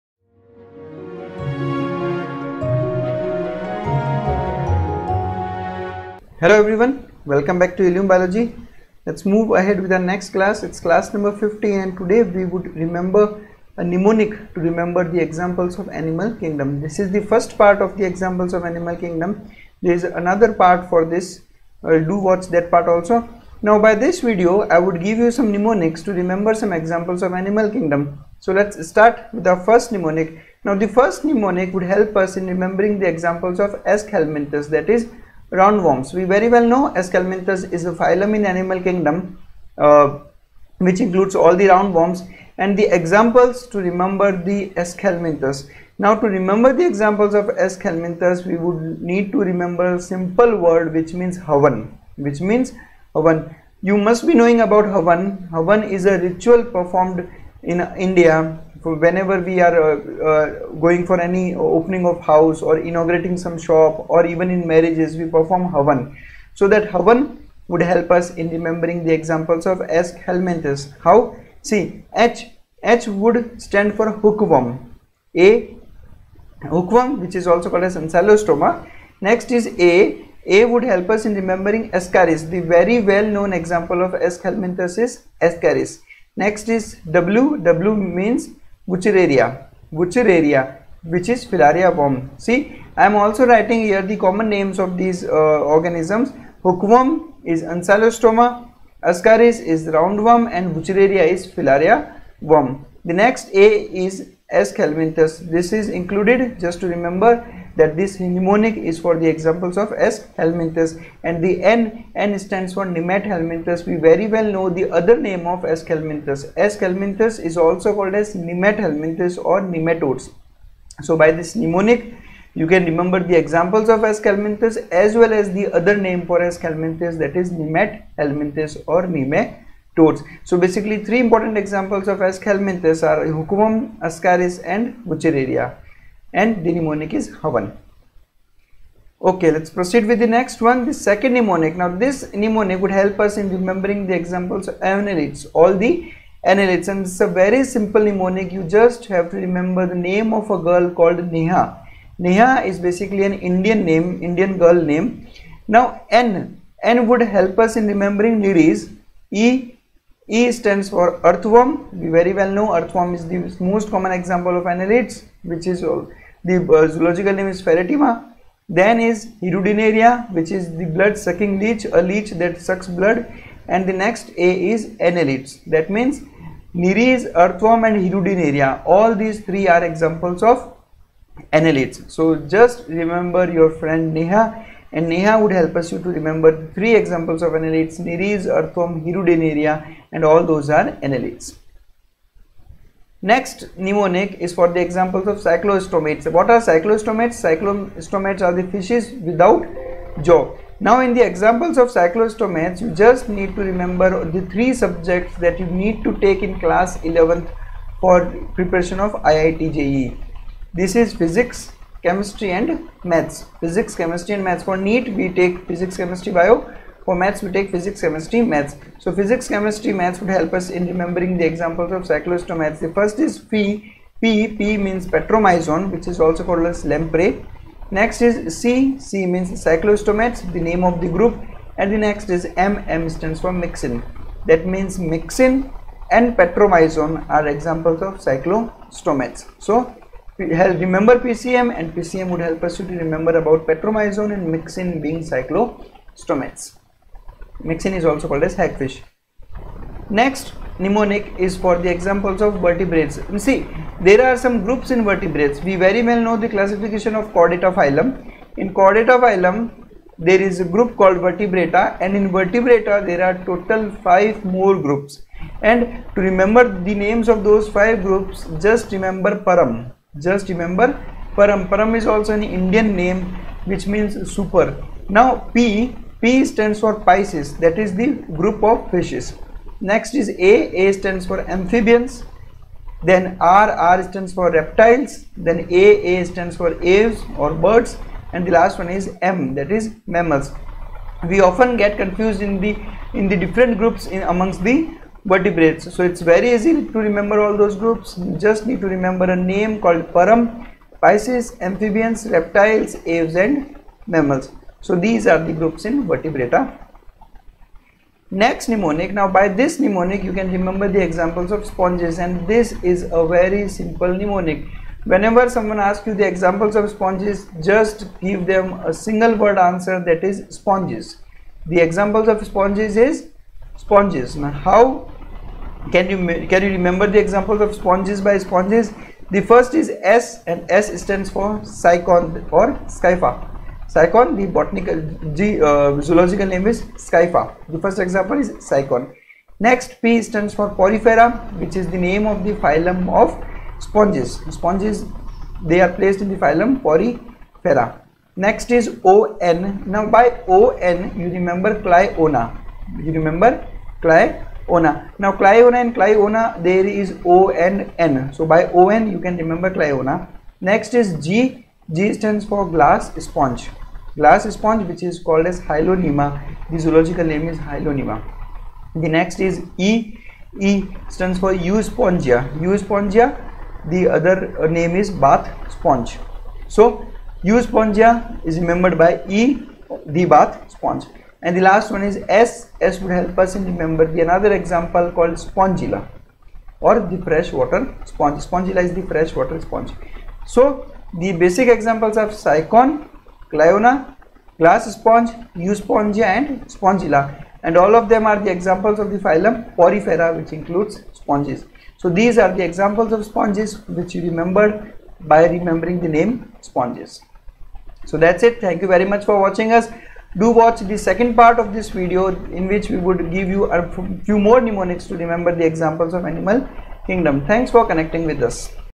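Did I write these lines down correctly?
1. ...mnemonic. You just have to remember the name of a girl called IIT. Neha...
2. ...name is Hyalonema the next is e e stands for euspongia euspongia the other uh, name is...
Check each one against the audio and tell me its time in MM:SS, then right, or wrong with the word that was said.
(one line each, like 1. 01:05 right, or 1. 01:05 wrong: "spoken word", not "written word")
1. 02:28 wrong: "Neha", not "IIT"
2. 06:07 right.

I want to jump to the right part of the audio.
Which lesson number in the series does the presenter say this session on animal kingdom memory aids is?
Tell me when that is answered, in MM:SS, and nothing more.
00:11.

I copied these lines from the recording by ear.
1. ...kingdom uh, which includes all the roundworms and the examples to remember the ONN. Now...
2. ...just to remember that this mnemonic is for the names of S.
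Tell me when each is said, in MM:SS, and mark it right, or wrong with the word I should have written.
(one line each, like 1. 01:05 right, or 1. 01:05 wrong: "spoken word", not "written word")
1. 00:38 wrong: "Aschelminthes", not "ONN"
2. 01:46 wrong: "examples", not "names".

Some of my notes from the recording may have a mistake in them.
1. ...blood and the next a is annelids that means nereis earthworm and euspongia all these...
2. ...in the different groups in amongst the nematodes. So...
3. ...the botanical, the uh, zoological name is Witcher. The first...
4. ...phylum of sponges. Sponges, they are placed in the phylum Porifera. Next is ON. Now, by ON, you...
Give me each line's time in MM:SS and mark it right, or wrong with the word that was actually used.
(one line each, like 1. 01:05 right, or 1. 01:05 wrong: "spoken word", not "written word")
1. 02:52 wrong: "hirudinaria", not "euspongia"
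2. 04:53 wrong: "vertebrates", not "nematodes"
3. 05:34 wrong: "Scypha", not "Witcher"
4. 05:42 right.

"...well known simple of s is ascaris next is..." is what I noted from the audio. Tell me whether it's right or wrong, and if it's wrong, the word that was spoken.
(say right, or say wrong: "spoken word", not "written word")
wrong: "example", not "simple".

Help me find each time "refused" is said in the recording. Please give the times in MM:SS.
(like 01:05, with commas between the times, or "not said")
not said.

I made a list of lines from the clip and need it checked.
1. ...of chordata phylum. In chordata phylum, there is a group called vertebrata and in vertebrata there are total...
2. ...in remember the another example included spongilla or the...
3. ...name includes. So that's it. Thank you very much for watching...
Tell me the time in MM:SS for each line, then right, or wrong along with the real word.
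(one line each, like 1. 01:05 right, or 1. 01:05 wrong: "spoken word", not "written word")
1. 04:17 right
2. 06:23 wrong: "called", not "included"
3. 06:46 wrong: "sponges", not "includes".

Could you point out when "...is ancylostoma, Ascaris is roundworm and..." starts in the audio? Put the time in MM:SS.
01:37.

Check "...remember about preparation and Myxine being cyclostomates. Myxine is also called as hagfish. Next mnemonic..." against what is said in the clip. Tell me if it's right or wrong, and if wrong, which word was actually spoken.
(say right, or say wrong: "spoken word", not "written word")
wrong: "petromyzon", not "preparation".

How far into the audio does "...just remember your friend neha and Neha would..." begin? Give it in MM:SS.
03:02.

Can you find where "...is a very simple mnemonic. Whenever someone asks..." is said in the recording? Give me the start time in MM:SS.
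05:12.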